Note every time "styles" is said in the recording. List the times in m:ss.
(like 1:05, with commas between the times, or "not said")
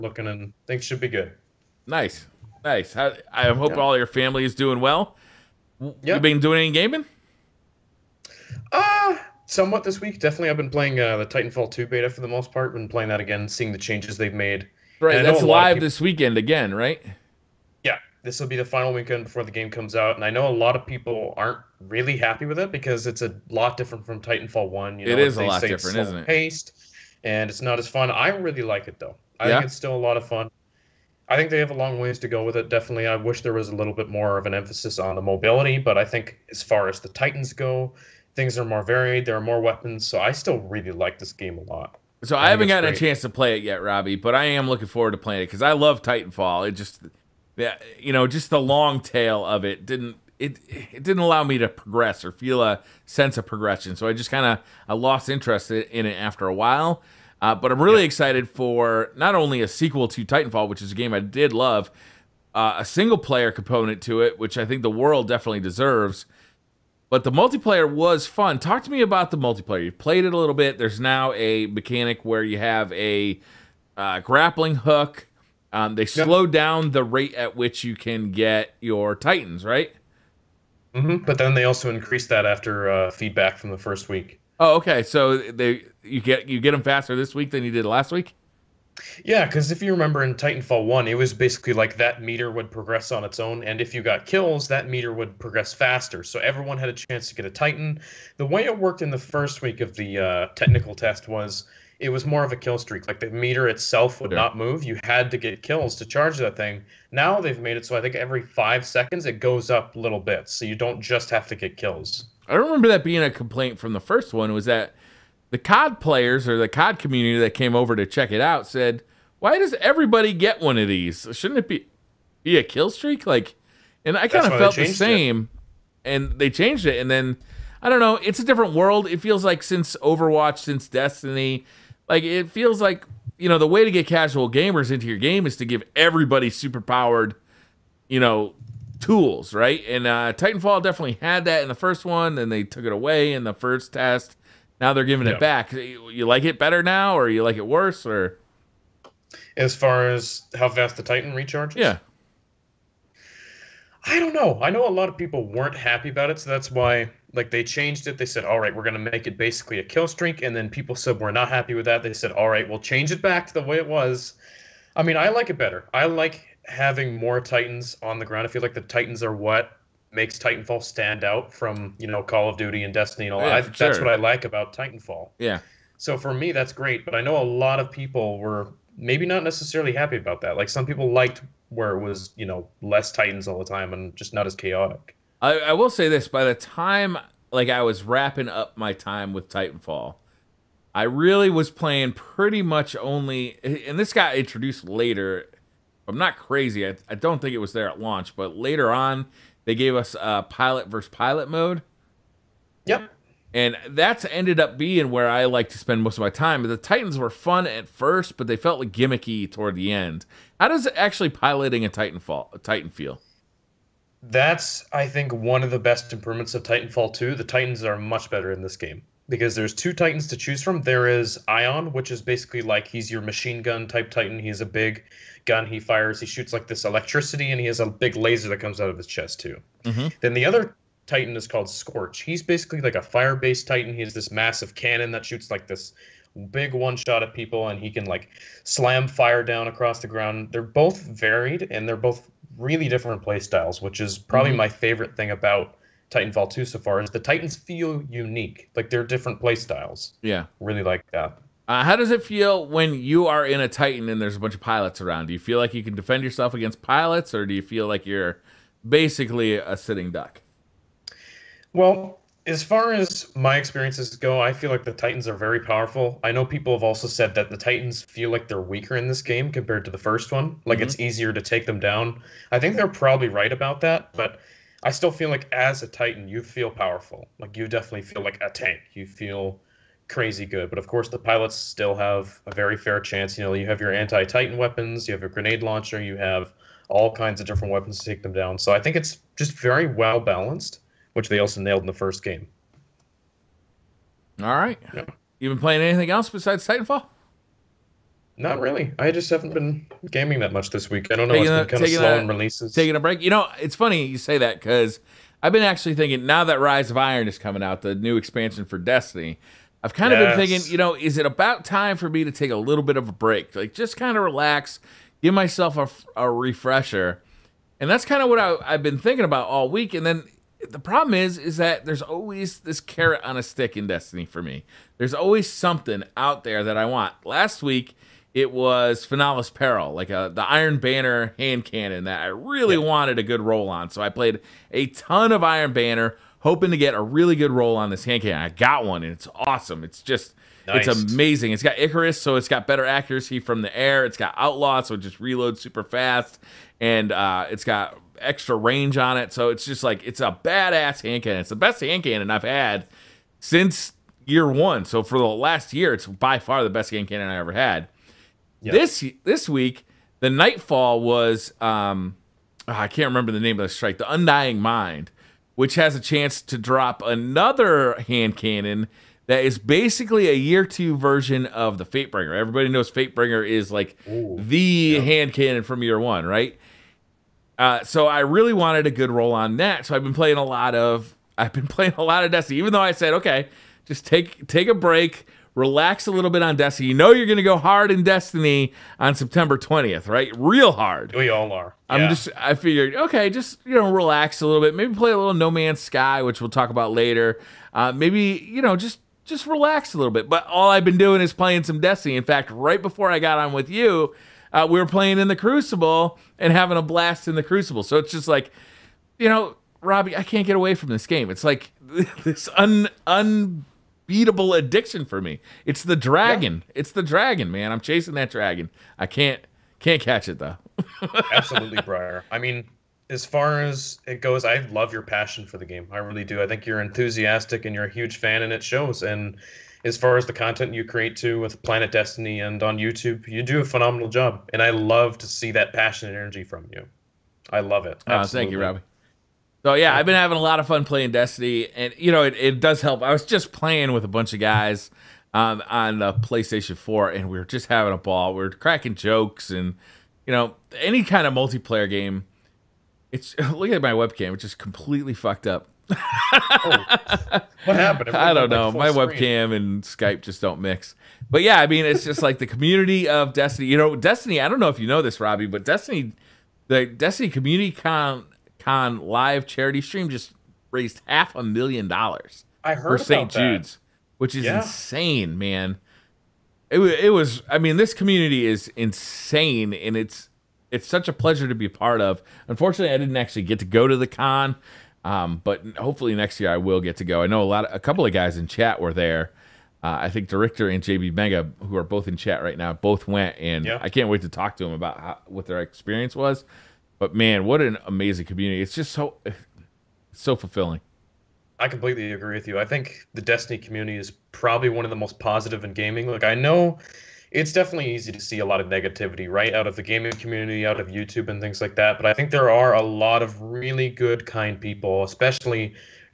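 4:03, 4:09.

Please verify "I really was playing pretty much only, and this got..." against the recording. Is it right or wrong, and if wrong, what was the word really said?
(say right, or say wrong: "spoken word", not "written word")
right.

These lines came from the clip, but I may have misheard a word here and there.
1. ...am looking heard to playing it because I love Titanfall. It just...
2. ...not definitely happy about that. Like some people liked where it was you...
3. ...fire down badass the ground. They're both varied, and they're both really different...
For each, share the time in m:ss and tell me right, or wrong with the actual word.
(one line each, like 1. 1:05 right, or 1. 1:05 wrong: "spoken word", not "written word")
1. 0:44 wrong: "forward", not "heard"
2. 2:59 wrong: "necessarily", not "definitely"
3. 3:59 wrong: "across", not "badass".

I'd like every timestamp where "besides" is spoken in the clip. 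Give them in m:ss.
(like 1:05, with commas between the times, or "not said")
4:56.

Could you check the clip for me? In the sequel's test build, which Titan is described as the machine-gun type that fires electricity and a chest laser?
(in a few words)
Ion.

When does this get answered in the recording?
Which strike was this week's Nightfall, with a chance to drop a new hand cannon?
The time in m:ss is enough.
6:03.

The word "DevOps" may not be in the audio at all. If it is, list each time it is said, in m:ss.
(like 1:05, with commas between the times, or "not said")
not said.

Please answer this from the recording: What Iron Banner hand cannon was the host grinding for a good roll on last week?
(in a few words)
Finnala's Peril.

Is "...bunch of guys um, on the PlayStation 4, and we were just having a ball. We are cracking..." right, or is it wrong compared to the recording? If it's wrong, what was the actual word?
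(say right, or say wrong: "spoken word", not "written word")
right.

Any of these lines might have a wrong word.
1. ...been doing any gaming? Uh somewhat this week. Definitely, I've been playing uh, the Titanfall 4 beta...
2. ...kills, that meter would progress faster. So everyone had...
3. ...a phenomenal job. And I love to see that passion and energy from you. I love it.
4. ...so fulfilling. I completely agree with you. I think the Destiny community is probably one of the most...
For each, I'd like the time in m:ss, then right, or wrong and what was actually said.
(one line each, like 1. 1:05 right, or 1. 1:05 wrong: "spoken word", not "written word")
1. 0:06 wrong: "2", not "4"
2. 1:34 right
3. 7:13 right
4. 8:20 right.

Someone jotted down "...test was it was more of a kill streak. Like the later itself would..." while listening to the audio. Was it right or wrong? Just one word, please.
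wrong.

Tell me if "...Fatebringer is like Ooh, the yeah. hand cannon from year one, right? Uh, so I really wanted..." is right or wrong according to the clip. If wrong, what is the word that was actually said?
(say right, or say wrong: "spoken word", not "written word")
right.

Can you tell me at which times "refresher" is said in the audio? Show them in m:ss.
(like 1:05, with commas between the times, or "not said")
5:16.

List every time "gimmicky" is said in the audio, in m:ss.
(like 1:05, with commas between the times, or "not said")
3:28.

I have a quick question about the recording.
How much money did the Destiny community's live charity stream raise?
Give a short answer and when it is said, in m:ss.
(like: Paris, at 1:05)
half a million dollars, at 7:51.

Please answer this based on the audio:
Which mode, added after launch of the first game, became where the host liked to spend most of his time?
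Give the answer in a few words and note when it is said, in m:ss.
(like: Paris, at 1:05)
pilot versus pilot, at 3:20.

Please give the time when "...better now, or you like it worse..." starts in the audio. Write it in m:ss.
2:26.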